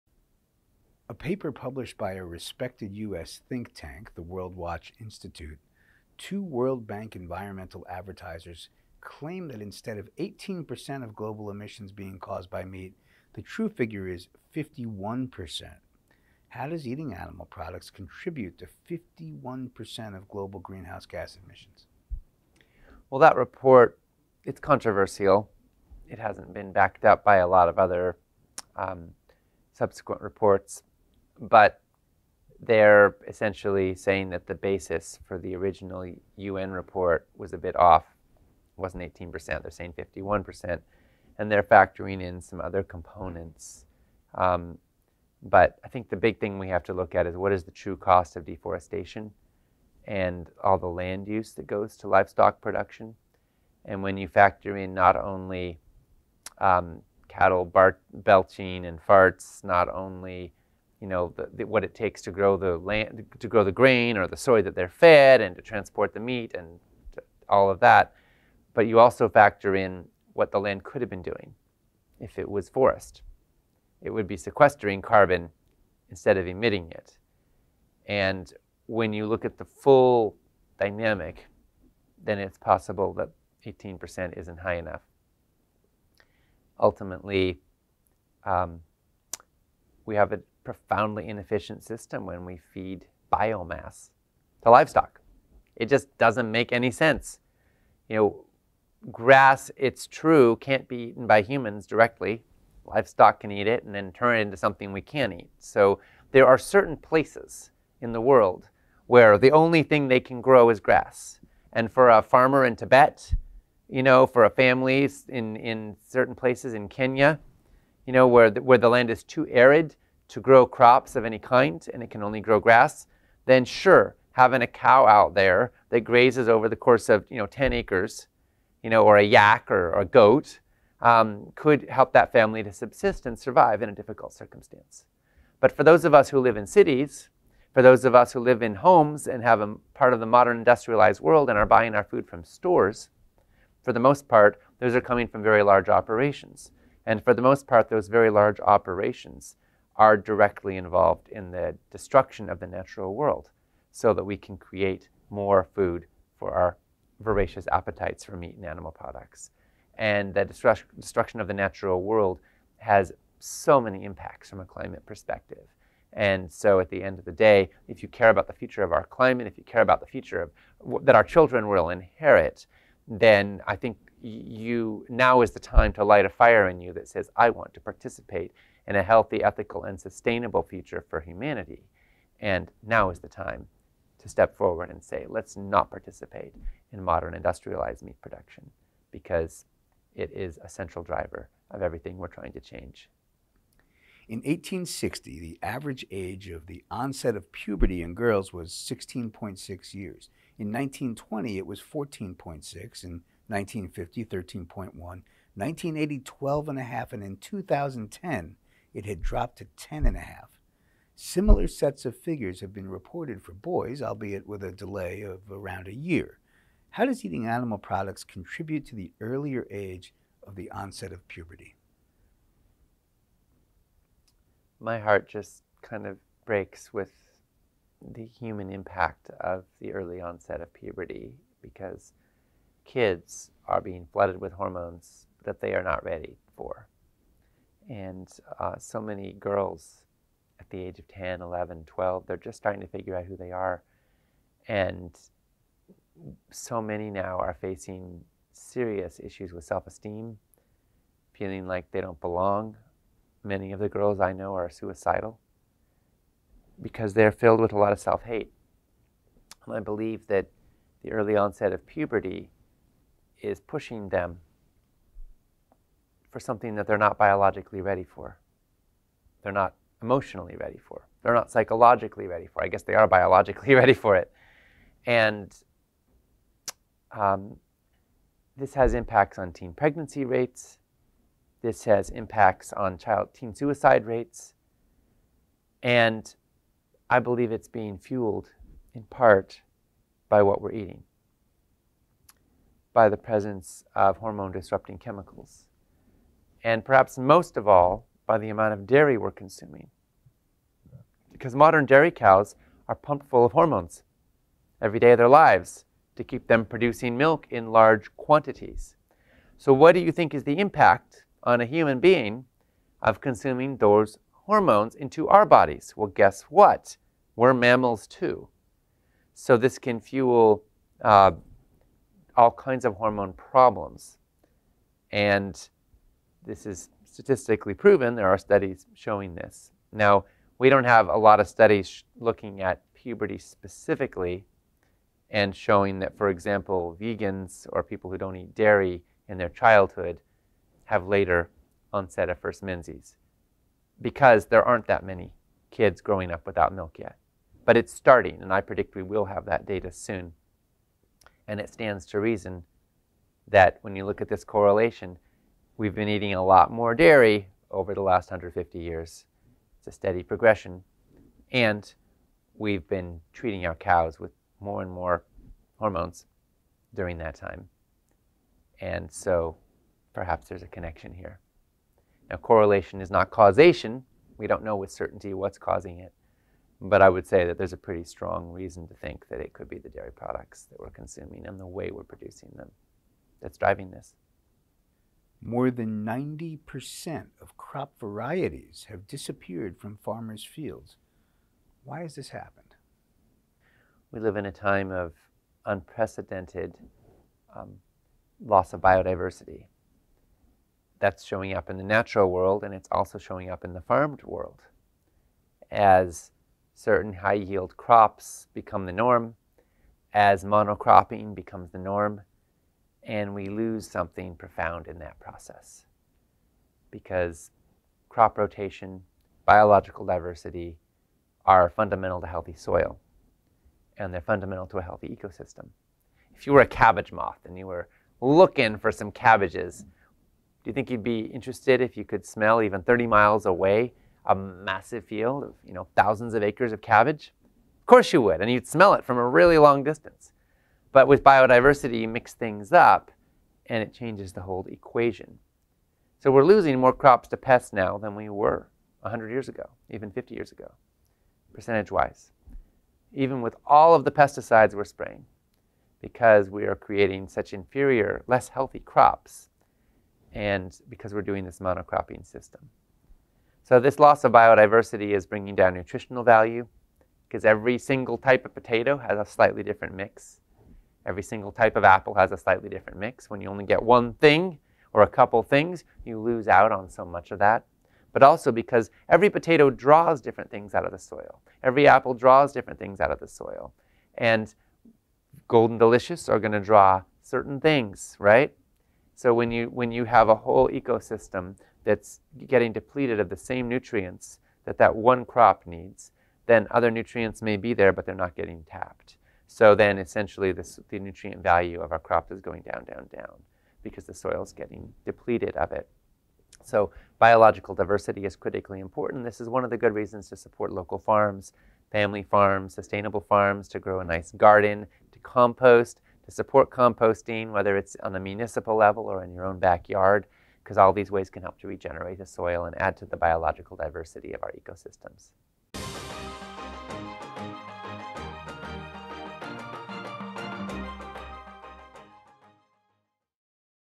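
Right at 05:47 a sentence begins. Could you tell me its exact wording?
But it's starting, and I predict we will have that data soon.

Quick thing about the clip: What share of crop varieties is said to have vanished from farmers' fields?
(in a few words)
More than 90%.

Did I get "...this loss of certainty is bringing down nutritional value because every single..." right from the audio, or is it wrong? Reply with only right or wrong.
wrong.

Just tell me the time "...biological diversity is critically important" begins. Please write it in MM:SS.
08:27.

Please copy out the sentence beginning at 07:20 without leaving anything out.
But with biodiversity, you mix things up and it changes the whole equation.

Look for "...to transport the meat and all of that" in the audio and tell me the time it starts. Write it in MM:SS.
01:05.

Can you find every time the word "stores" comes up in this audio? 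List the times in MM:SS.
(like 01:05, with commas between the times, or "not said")
02:22.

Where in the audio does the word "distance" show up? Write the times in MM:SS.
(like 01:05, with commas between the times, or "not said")
07:19.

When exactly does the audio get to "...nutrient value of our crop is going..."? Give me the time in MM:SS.
08:20.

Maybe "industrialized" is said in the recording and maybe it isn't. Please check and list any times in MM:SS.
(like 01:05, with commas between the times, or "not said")
02:20, 03:07.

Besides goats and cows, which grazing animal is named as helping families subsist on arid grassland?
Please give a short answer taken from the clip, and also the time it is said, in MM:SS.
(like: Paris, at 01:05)
yak, at 02:09.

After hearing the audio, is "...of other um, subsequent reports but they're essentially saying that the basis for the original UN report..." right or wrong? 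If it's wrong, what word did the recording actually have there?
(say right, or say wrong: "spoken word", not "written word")
right.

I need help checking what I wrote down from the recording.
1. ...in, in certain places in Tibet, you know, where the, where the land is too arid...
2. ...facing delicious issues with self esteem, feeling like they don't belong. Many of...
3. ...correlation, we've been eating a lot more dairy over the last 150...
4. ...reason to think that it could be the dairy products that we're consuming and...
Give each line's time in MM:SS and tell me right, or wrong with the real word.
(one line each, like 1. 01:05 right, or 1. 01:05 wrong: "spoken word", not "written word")
1. 01:55 wrong: "Kenya", not "Tibet"
2. 04:07 wrong: "serious", not "delicious"
3. 05:54 right
4. 06:18 right.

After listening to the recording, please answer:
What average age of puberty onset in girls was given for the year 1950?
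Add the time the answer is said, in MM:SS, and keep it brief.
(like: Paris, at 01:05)
13.1, at 03:24.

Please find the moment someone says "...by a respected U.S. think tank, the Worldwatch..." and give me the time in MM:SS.
00:01.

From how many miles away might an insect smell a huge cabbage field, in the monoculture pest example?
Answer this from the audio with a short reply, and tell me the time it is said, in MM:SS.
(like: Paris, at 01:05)
30 miles, at 07:12.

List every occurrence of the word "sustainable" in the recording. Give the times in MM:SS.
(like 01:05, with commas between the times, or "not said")
02:59, 08:32.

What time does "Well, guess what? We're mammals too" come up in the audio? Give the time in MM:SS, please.
05:15.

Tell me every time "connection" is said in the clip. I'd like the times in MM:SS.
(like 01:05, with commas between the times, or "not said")
06:10.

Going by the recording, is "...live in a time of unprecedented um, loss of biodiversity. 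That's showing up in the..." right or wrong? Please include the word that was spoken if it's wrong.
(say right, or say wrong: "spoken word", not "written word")
right.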